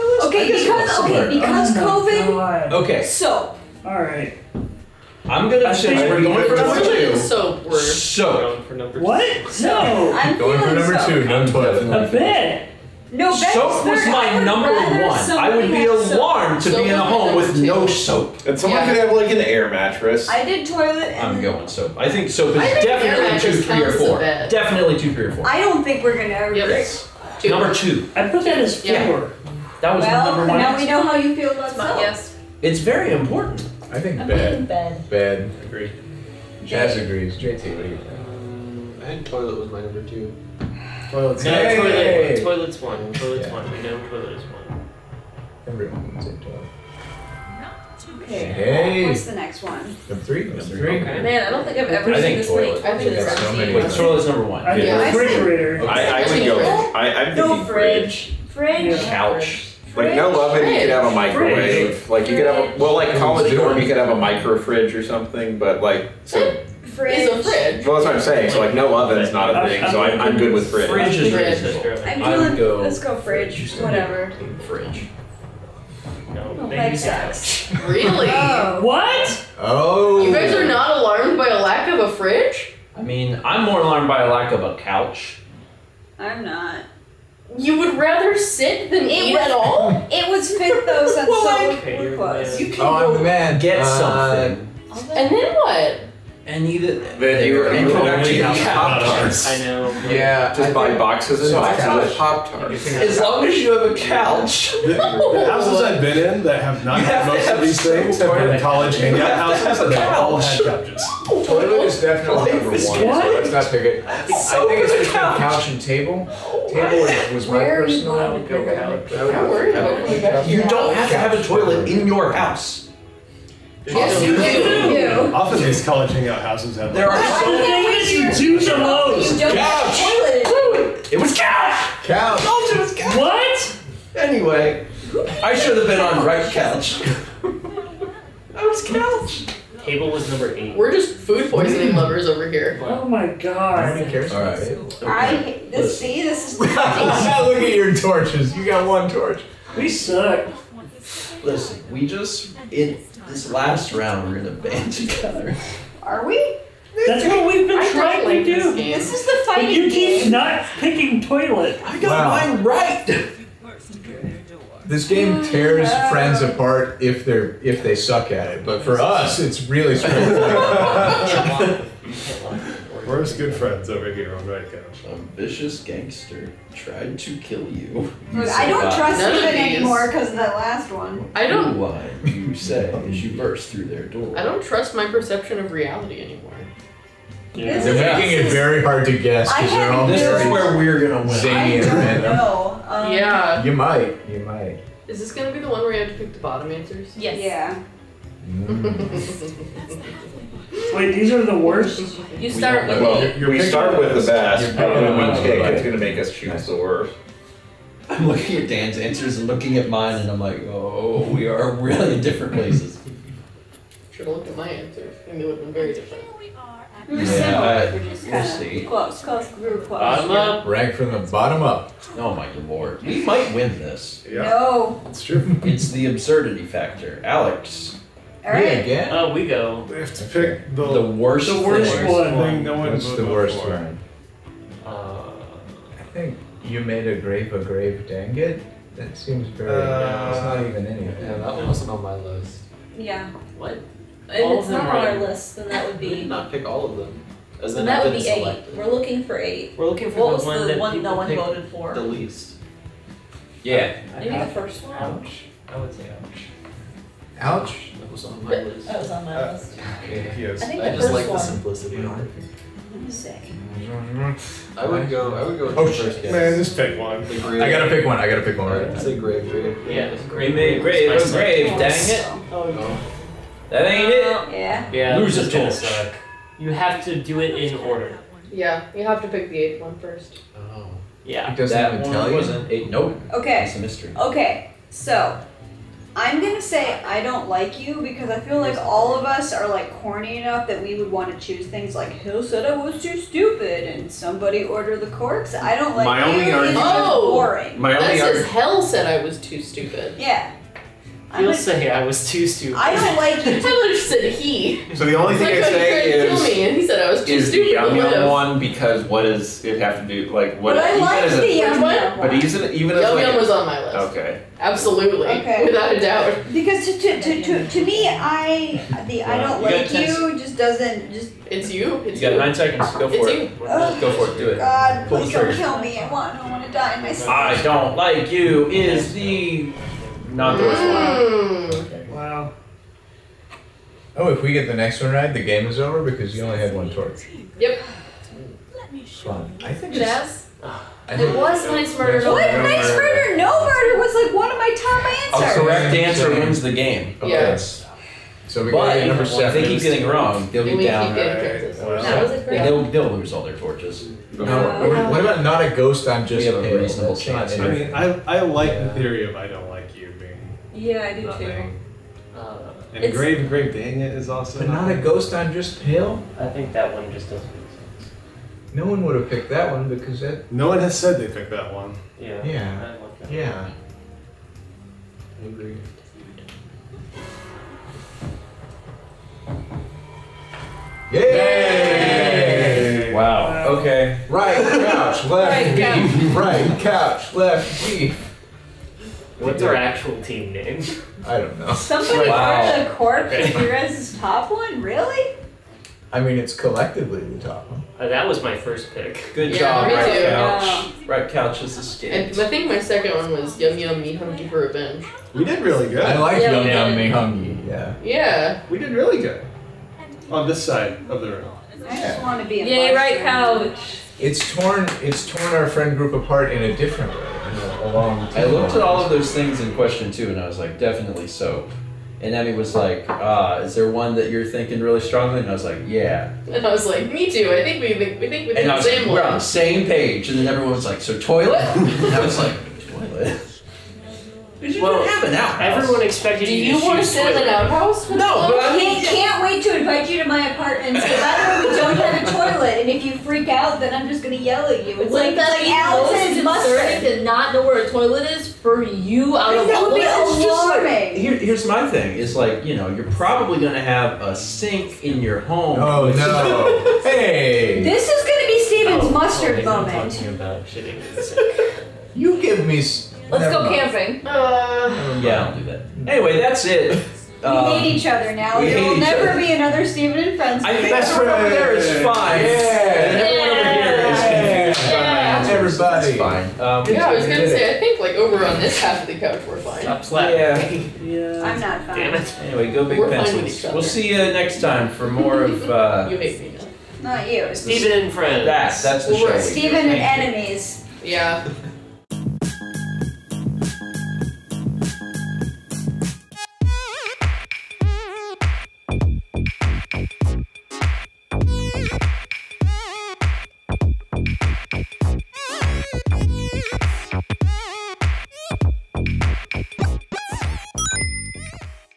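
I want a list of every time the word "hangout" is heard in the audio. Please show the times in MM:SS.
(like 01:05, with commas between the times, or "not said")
01:48, 02:06.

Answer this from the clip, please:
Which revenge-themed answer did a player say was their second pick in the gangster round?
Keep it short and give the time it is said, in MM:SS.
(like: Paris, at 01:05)
Yum Yum Me Hungry for Revenge, at 06:43.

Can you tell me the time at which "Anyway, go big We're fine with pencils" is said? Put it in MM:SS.
08:02.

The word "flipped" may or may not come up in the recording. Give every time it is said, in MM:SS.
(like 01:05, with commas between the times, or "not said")
not said.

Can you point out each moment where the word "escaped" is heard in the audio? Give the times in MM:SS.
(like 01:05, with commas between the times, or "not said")
06:41.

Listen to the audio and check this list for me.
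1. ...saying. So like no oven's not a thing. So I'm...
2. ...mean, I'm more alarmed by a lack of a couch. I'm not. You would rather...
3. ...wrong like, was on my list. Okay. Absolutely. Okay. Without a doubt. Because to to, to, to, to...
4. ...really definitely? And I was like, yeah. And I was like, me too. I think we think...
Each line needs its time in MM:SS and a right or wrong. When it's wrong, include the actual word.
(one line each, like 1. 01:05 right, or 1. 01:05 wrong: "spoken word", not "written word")
1. 01:08 right
2. 01:23 right
3. 05:12 wrong: "young", not "wrong"
4. 07:04 wrong: "strongly", not "definitely".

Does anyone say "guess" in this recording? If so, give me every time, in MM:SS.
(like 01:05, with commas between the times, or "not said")
03:09, 04:26.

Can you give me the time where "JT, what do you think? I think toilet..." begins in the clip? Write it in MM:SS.
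00:37.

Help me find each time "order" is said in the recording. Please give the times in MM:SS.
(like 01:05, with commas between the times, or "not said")
04:37, 04:54.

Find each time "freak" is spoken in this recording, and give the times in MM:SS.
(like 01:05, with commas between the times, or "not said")
07:23.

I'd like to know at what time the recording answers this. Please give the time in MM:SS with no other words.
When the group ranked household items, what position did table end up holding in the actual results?
02:19.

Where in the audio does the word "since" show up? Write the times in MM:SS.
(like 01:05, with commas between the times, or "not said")
00:05, 01:31.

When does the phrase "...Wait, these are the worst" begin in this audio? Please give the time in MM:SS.
03:20.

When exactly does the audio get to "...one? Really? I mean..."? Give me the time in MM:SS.
06:34.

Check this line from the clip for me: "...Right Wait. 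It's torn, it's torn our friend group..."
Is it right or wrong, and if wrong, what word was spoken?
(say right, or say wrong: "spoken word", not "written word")
wrong: "Couch", not "Wait".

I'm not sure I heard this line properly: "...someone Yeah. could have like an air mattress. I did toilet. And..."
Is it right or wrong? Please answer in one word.
right.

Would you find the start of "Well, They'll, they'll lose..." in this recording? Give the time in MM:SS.
05:51.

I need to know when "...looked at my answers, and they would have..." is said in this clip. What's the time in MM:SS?
03:34.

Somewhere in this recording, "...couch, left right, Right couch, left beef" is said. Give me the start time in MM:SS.
06:24.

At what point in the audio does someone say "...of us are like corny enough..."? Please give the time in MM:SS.
04:49.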